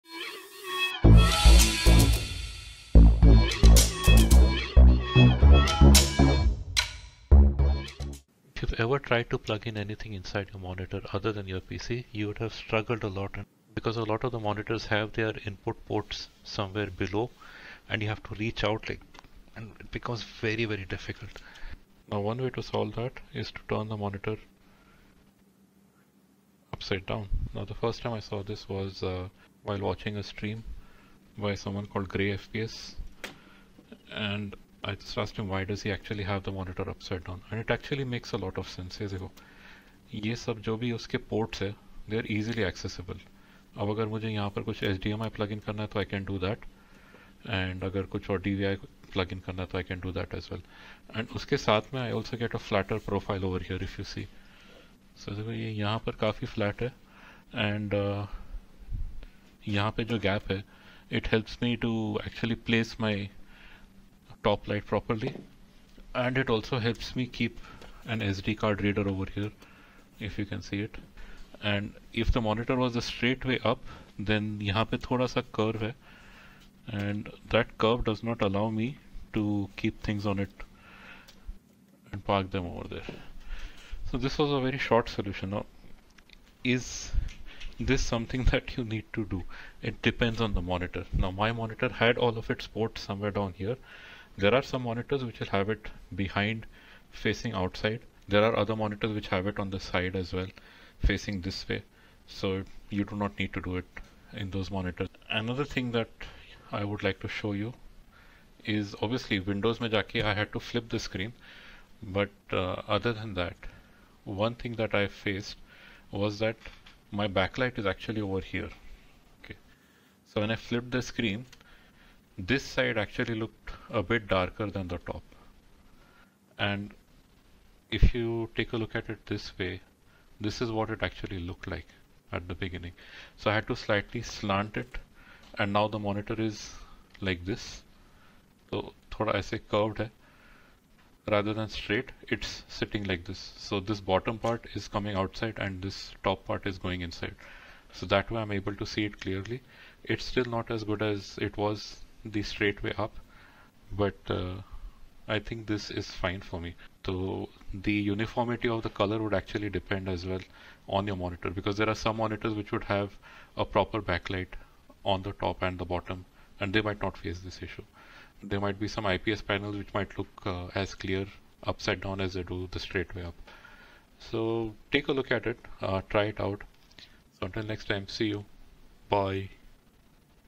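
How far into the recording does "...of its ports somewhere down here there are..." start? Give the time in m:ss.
1:32.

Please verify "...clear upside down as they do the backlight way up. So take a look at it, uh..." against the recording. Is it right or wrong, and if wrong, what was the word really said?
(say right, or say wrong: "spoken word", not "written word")
wrong: "straight", not "backlight".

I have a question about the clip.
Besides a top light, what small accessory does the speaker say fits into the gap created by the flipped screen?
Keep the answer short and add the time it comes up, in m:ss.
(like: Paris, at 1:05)
SD card reader, at 1:08.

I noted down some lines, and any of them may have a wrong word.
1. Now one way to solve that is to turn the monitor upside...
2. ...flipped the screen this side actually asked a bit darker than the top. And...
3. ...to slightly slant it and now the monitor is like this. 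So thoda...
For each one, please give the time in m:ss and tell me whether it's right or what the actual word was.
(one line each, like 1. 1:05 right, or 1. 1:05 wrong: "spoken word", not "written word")
1. 0:22 right
2. 2:00 wrong: "looked", not "asked"
3. 2:13 right.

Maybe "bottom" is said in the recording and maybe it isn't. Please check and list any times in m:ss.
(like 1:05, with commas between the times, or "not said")
2:23, 2:45.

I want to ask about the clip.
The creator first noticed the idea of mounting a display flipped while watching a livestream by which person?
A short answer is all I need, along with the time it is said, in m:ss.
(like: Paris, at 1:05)
GrayFPS, at 0:32.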